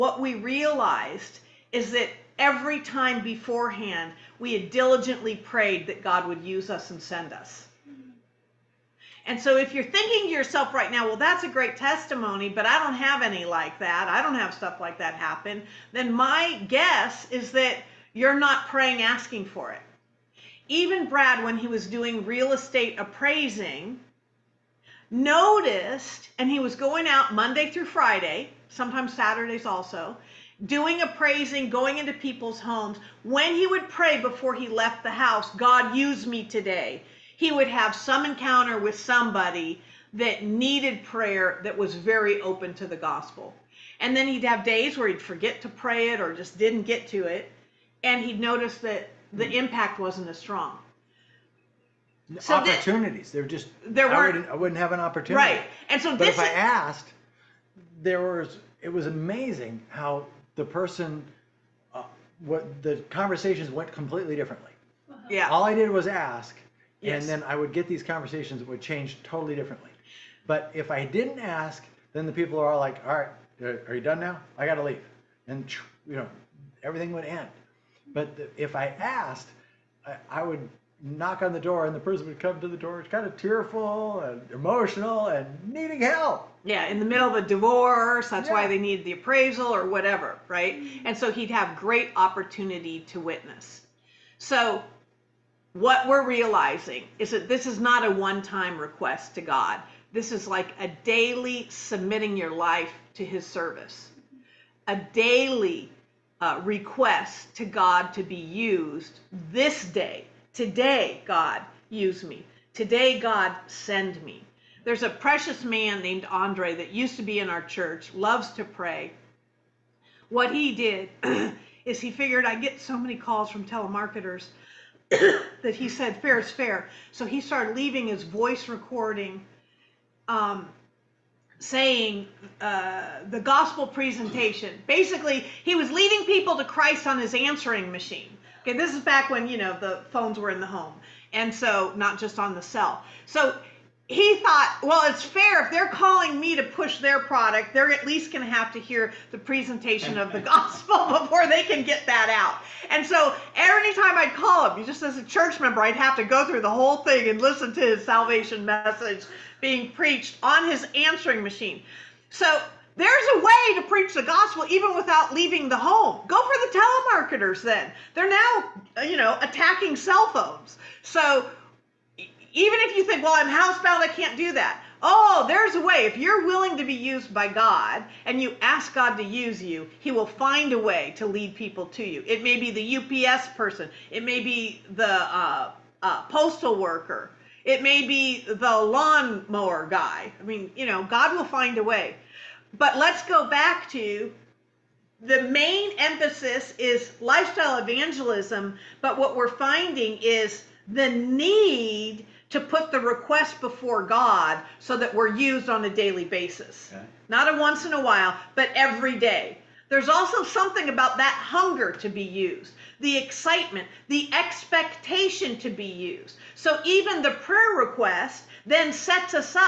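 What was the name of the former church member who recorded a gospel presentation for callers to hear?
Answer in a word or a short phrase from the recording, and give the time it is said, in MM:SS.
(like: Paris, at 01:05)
Andre, at 01:56.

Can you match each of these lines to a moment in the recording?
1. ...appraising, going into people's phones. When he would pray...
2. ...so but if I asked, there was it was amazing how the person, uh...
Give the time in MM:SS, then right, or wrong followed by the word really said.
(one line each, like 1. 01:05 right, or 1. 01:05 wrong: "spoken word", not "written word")
1. 00:31 wrong: "homes", not "phones"
2. 00:56 right.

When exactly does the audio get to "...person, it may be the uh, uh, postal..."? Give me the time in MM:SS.
03:03.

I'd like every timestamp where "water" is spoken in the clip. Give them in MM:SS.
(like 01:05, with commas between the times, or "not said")
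not said.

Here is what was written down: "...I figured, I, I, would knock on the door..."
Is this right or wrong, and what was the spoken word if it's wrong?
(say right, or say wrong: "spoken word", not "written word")
wrong: "asked", not "figured".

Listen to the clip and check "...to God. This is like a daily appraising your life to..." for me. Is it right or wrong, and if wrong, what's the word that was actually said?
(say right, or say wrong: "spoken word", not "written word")
wrong: "submitting", not "appraising".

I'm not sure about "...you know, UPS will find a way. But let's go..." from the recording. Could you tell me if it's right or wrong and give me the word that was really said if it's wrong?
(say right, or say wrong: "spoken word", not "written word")
wrong: "God", not "UPS".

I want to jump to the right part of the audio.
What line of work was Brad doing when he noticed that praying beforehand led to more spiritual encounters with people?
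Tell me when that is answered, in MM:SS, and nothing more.
00:22.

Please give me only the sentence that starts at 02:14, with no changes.
Basically, he was leading people to Christ on his answering machine.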